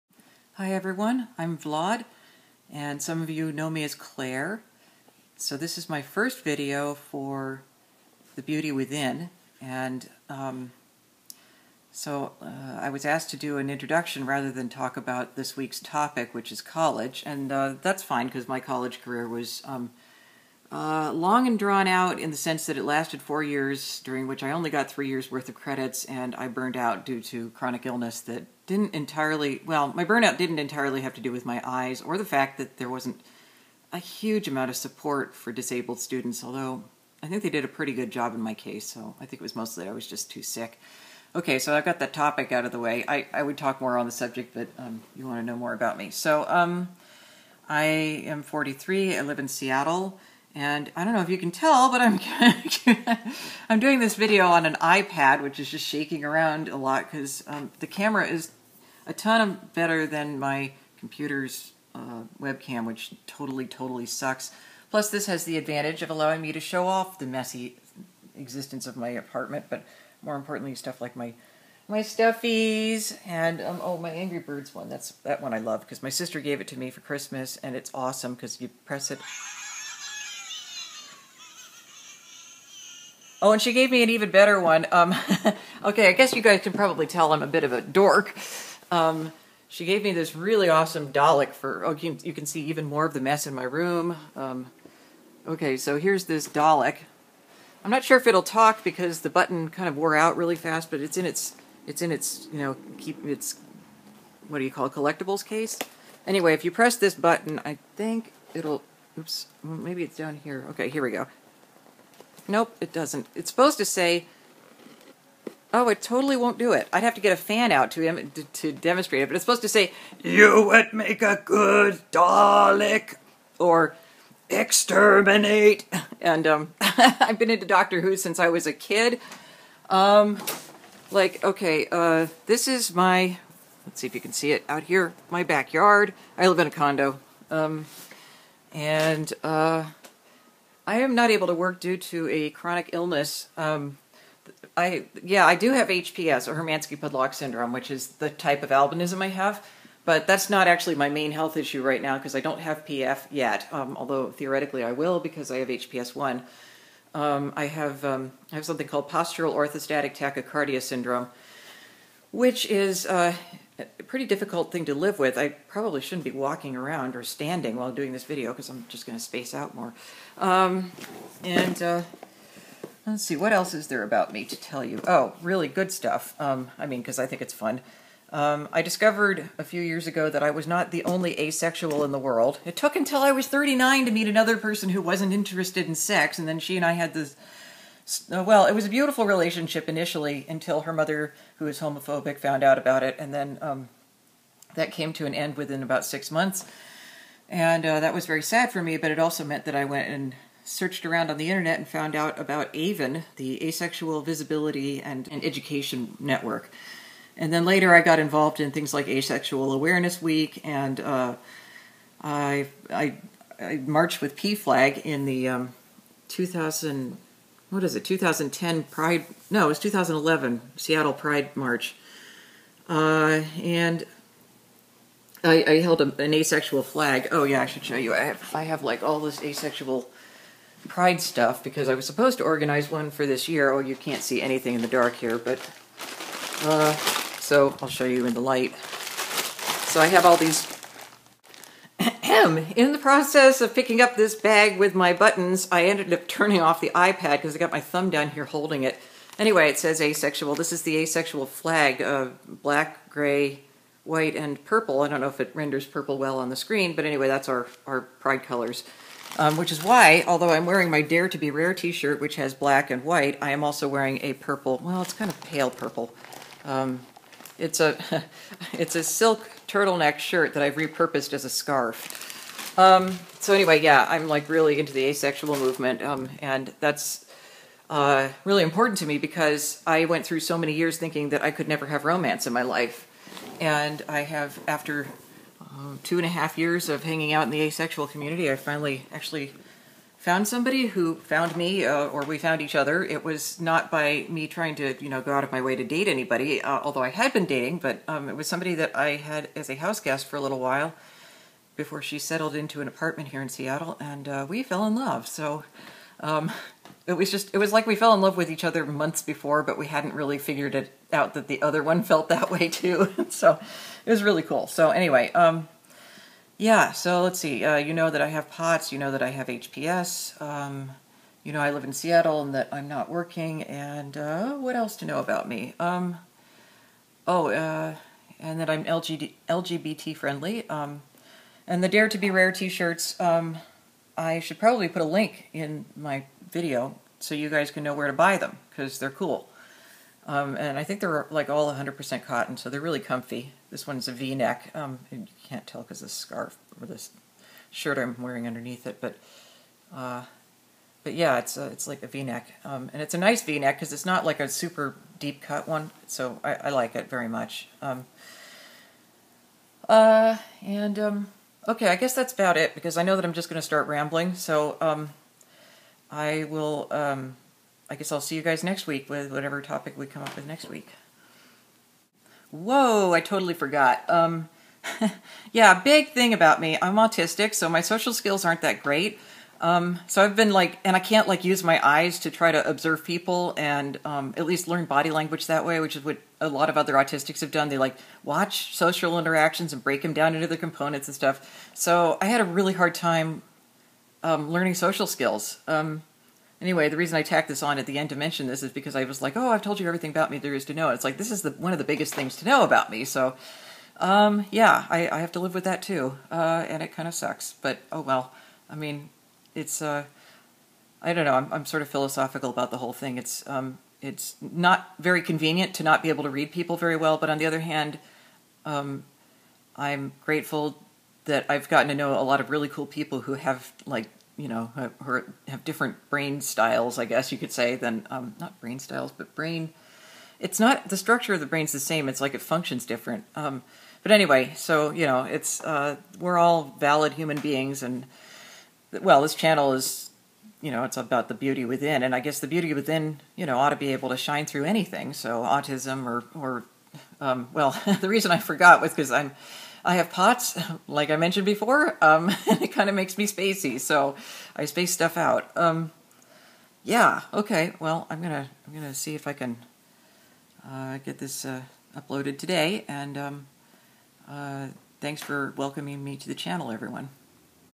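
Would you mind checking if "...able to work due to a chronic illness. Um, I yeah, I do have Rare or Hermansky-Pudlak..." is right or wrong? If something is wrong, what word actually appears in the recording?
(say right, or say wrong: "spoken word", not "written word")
wrong: "HPS", not "Rare".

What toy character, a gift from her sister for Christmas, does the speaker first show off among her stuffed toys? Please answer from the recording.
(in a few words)
Angry Birds.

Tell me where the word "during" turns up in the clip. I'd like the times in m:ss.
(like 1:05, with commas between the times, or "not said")
0:24.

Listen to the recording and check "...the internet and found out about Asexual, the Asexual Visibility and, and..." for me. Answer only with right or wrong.
wrong.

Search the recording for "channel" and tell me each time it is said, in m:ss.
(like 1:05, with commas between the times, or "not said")
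7:19, 7:46.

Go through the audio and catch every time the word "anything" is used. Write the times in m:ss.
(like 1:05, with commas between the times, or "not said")
3:54, 7:24.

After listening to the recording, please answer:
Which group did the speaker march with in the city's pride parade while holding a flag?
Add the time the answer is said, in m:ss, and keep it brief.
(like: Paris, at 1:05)
PFLAG, at 3:34.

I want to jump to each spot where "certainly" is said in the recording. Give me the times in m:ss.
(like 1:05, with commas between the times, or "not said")
not said.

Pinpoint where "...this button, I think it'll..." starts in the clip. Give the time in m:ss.
1:46.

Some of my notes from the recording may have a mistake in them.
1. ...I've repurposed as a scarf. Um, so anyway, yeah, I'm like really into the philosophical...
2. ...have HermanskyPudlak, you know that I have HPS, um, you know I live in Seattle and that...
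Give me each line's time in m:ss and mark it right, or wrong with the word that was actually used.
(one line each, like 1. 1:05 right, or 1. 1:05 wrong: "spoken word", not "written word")
1. 4:30 wrong: "asexual", not "philosophical"
2. 5:18 wrong: "POTS", not "HermanskyPudlak".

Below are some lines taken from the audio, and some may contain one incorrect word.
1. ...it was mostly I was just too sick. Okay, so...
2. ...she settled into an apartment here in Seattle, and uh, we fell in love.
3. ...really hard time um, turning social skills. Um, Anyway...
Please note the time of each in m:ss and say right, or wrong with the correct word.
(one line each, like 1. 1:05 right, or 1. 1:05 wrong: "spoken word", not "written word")
1. 0:39 right
2. 5:02 right
3. 6:32 wrong: "learning", not "turning".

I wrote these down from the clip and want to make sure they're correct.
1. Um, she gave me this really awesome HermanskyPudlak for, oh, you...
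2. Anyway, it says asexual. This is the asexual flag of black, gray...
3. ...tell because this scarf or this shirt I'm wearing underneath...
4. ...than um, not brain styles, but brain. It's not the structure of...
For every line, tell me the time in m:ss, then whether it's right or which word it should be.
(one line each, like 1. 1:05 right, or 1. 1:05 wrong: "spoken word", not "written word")
1. 1:28 wrong: "Dalek", not "HermanskyPudlak"
2. 4:09 right
3. 5:45 right
4. 7:07 right.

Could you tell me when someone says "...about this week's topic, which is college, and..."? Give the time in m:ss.
0:14.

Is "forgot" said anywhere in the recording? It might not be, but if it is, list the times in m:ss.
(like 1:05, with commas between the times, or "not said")
6:13, 7:28.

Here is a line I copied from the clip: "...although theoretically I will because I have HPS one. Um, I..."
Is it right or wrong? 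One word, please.
right.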